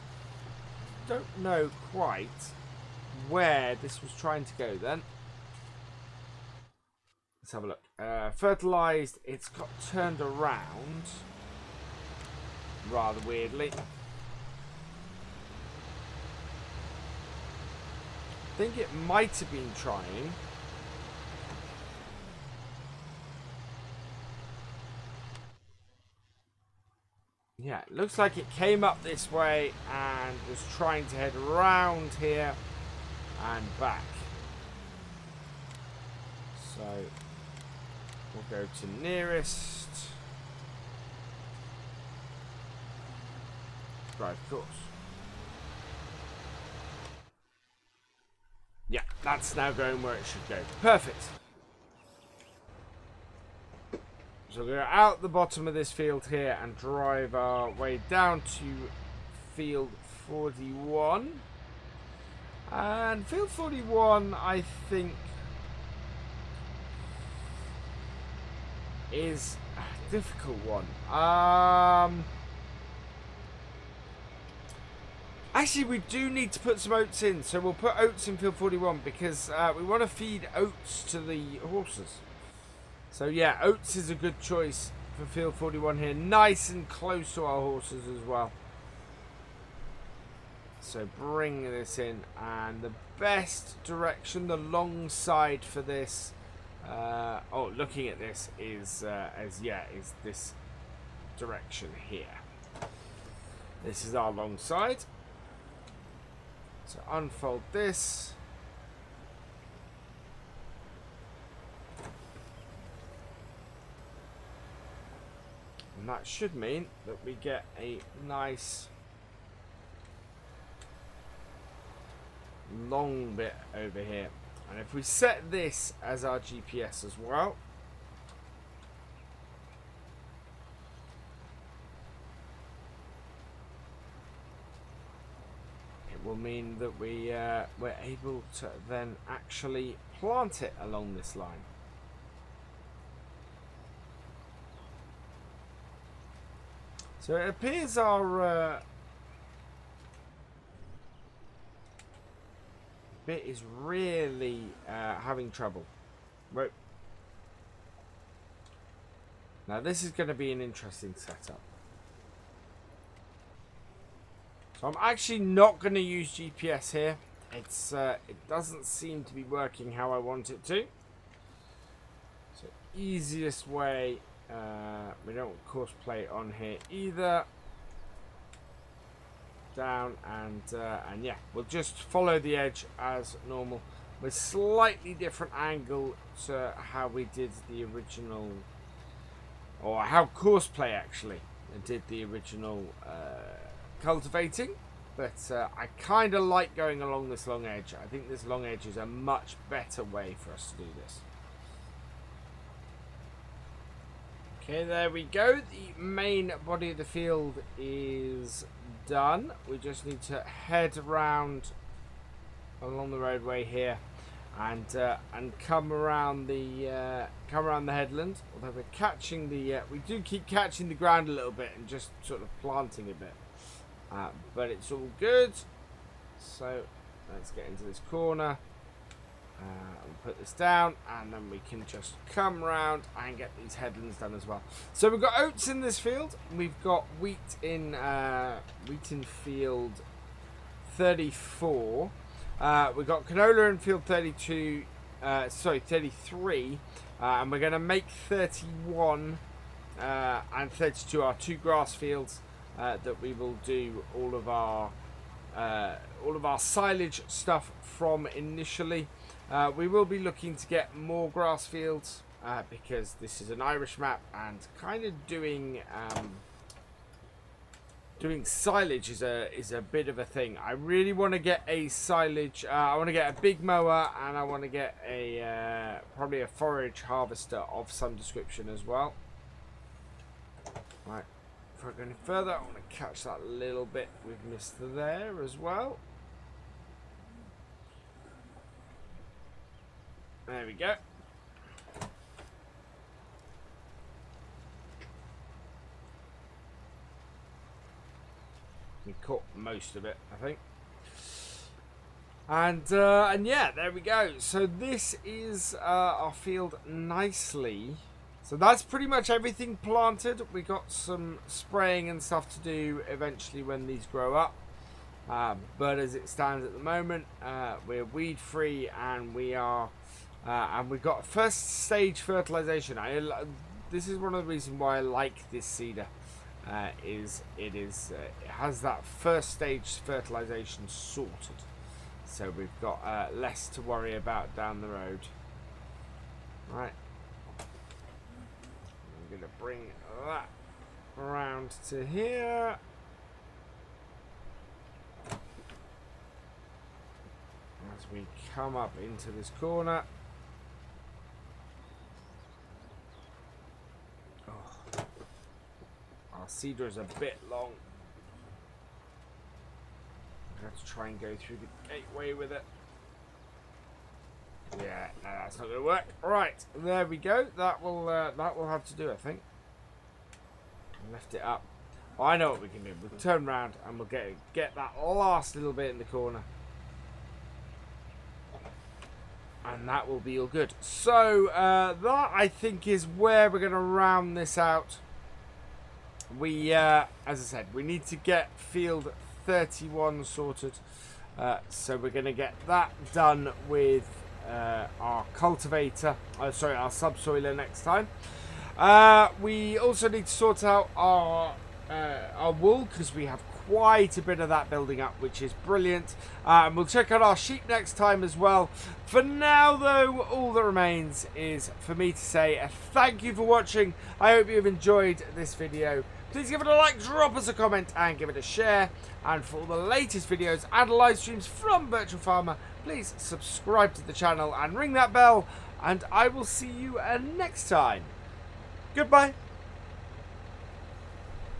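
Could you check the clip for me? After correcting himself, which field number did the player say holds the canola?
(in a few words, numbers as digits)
33.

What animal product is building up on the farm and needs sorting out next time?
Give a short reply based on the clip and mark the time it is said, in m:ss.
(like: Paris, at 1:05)
Wool, at 6:42.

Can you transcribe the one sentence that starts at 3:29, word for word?
We just need to head around along the roadway here and uh, and come around the uh, come around the headland.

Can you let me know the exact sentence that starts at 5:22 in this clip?
I, uh, this is one of the reasons why I like this seeder.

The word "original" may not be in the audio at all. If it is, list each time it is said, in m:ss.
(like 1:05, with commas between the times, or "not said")
3:07, 3:12.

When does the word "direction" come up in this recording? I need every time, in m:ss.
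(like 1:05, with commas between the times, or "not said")
1:33, 1:41.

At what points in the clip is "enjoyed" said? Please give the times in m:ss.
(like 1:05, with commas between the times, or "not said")
6:54.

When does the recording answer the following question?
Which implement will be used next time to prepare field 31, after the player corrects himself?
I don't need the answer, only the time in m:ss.
6:36.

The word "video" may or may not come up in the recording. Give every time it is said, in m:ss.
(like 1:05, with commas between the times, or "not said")
6:55, 7:00.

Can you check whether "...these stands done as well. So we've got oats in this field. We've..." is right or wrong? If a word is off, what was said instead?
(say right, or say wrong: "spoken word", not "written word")
wrong: "headlands", not "stands".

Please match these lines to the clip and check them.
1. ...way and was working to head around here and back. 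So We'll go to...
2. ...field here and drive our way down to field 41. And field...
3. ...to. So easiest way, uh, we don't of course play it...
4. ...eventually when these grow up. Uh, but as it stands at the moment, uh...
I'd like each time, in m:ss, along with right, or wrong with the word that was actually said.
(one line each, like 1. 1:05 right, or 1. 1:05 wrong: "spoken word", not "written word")
1. 0:29 wrong: "trying", not "working"
2. 0:55 right
3. 2:50 right
4. 5:13 right.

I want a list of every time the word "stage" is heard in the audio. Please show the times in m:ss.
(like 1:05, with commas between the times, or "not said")
5:21, 5:29.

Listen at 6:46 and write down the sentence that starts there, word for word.
Uh, and we'll check out our sheep next time as well.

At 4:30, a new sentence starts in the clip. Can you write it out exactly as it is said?
I really want to get a silage.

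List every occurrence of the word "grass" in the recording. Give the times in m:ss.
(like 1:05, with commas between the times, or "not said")
4:11, 4:21.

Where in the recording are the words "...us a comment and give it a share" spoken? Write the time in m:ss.
6:57.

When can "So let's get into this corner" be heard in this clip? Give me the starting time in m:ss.
3:46.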